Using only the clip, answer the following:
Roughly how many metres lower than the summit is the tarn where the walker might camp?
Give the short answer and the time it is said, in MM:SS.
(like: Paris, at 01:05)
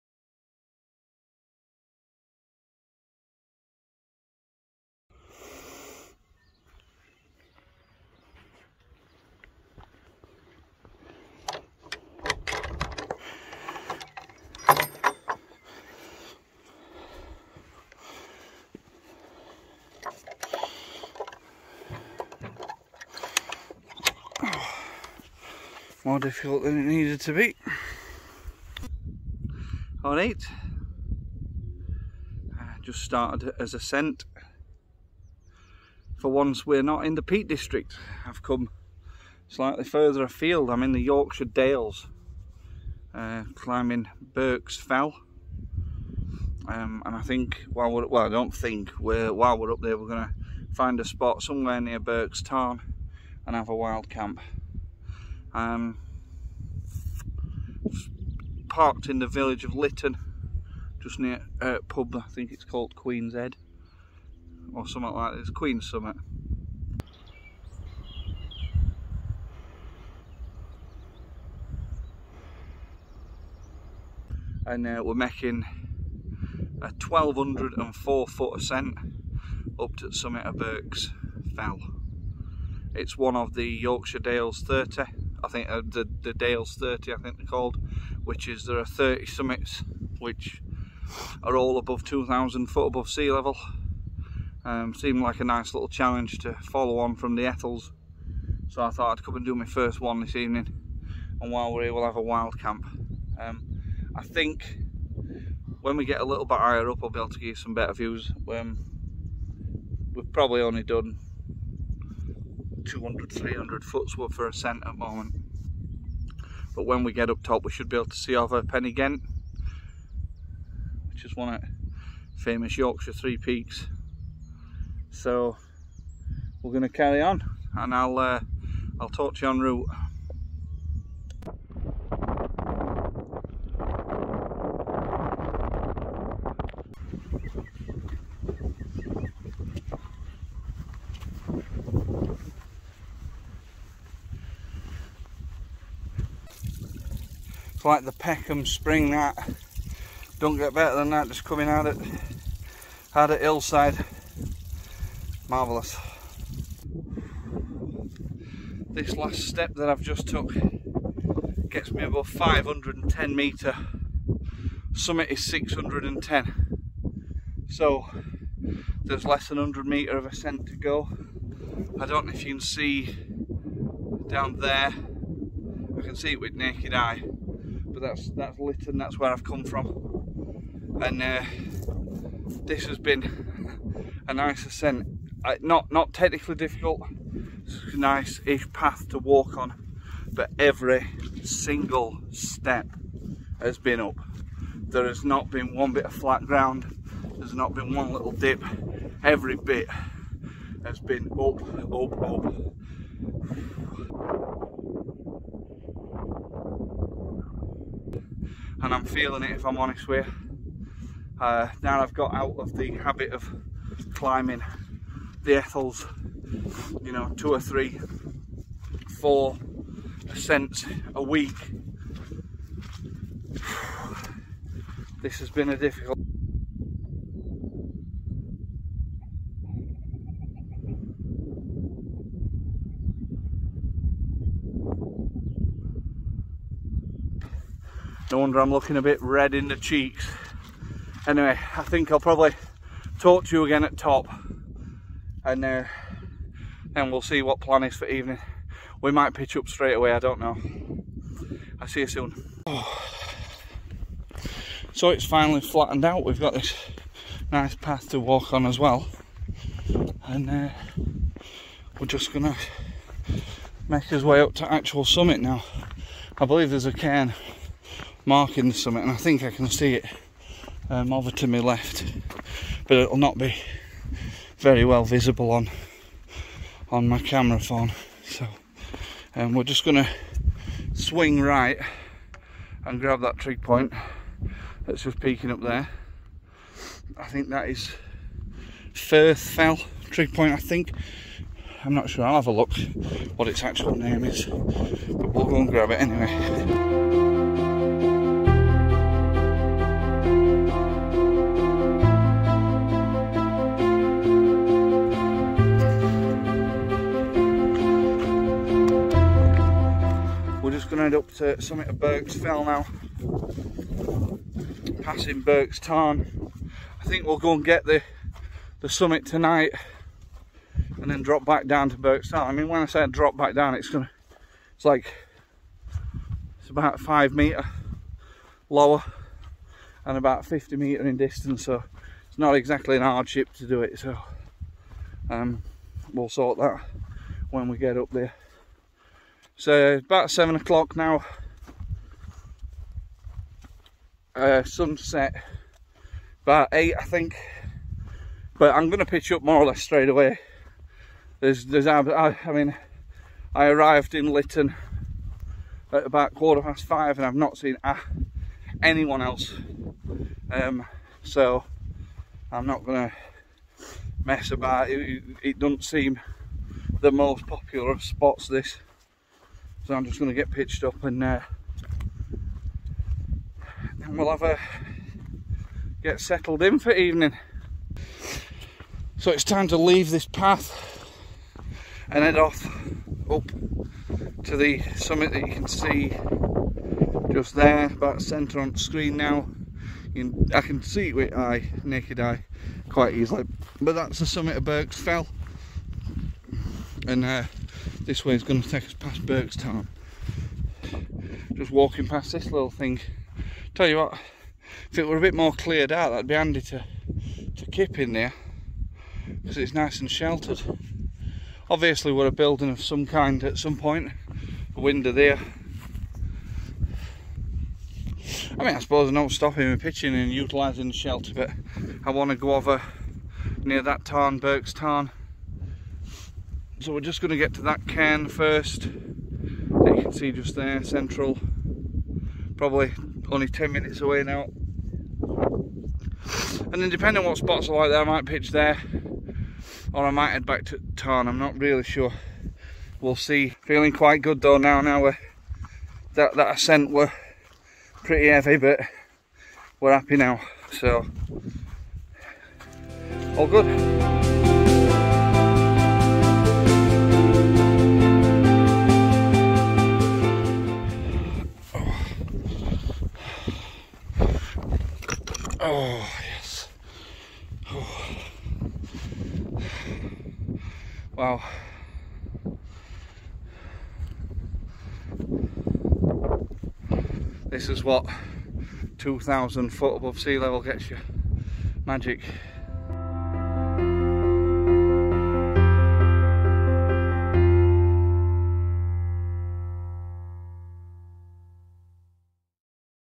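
5 metres, at 05:26.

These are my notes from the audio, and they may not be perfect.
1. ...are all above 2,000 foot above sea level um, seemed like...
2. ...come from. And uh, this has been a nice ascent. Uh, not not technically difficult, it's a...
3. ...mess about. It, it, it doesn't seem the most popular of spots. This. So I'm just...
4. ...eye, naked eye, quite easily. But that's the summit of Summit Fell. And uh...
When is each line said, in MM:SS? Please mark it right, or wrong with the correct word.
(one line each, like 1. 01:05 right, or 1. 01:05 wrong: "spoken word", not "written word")
1. 01:31 right
2. 02:59 right
3. 06:04 right
4. 06:31 wrong: "Birks", not "Summit".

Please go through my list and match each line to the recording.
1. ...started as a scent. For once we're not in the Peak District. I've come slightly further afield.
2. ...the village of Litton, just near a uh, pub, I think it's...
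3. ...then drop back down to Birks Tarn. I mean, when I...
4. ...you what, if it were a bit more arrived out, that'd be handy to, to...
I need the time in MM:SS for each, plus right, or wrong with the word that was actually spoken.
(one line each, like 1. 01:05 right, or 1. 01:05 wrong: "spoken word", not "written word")
1. 00:33 right
2. 00:59 right
3. 05:21 right
4. 06:43 wrong: "cleared", not "arrived".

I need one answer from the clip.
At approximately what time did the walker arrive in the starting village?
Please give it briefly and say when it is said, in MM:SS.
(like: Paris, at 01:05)
quarter past five, at 05:56.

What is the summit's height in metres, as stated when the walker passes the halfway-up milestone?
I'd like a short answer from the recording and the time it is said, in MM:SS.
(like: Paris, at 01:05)
610, at 02:45.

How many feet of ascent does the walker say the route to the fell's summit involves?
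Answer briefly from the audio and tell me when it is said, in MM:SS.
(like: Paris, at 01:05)
1204, at 01:17.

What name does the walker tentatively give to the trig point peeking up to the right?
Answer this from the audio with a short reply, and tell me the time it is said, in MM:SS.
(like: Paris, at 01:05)
Firth Fell, at 04:48.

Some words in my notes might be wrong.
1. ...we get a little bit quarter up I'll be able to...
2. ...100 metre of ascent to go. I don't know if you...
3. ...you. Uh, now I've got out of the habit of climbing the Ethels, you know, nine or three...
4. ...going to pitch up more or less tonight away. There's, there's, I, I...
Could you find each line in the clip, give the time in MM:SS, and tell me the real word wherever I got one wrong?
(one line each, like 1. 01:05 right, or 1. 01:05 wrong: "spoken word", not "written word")
1. 01:45 wrong: "higher", not "quarter"
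2. 02:49 right
3. 03:30 wrong: "two", not "nine"
4. 05:48 wrong: "straight", not "tonight".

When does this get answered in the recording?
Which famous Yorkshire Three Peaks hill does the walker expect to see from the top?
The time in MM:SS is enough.
01:58.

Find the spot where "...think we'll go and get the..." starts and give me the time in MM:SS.
05:17.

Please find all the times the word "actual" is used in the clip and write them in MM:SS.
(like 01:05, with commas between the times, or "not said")
04:24, 04:53.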